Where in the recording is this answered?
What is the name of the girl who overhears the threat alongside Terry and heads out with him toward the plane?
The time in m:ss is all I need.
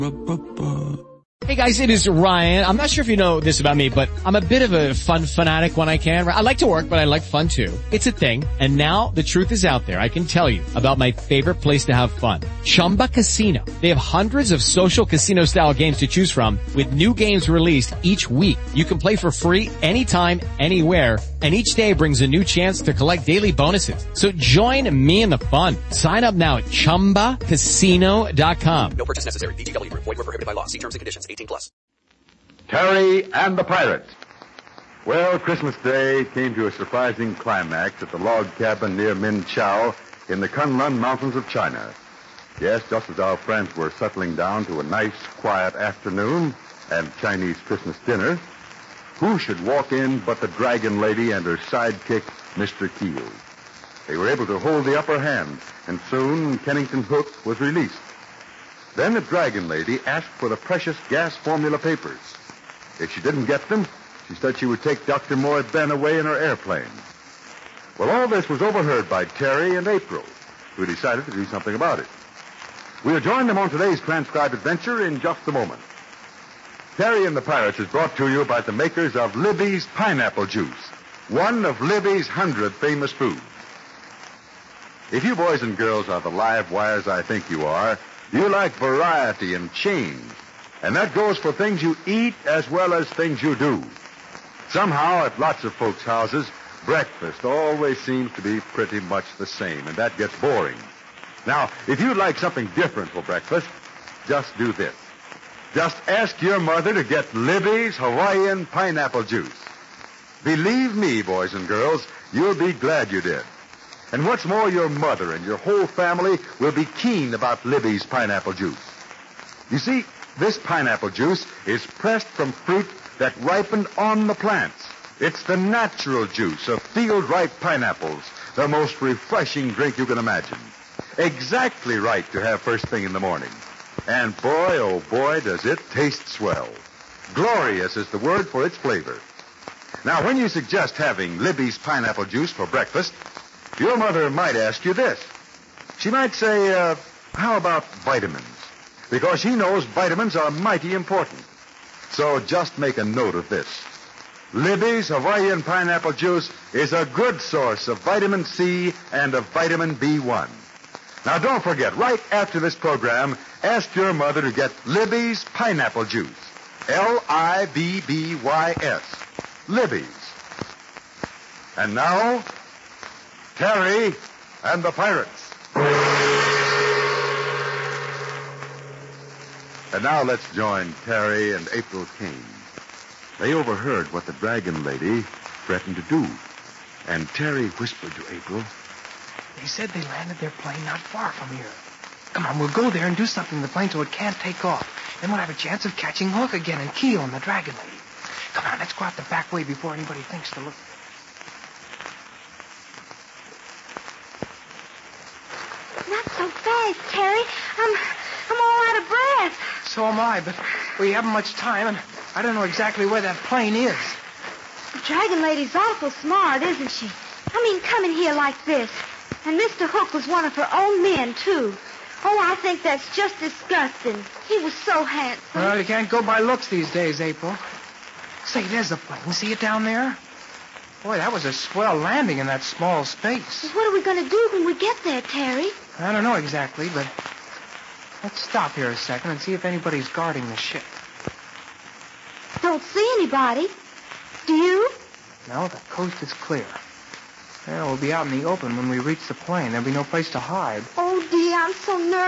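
3:01.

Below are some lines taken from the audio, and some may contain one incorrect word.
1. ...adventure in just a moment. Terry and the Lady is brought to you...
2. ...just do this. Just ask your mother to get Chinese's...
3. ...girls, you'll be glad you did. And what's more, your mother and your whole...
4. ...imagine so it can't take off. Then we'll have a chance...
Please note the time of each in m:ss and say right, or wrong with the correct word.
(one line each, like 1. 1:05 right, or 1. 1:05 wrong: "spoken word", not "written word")
1. 1:14 wrong: "Pirates", not "Lady"
2. 1:44 wrong: "Libby", not "Chinese"
3. 1:51 right
4. 3:13 wrong: "plane", not "imagine".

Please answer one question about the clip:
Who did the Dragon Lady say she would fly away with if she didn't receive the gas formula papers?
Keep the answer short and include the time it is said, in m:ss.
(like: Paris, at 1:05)
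Dr. Moore Ben, at 1:05.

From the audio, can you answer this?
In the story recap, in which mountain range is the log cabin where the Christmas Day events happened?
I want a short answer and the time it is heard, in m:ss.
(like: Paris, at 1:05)
Kunlun Mountains, at 0:40.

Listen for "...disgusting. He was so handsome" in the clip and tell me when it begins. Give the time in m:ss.
3:43.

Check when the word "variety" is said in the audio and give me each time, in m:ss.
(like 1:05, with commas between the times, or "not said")
1:28.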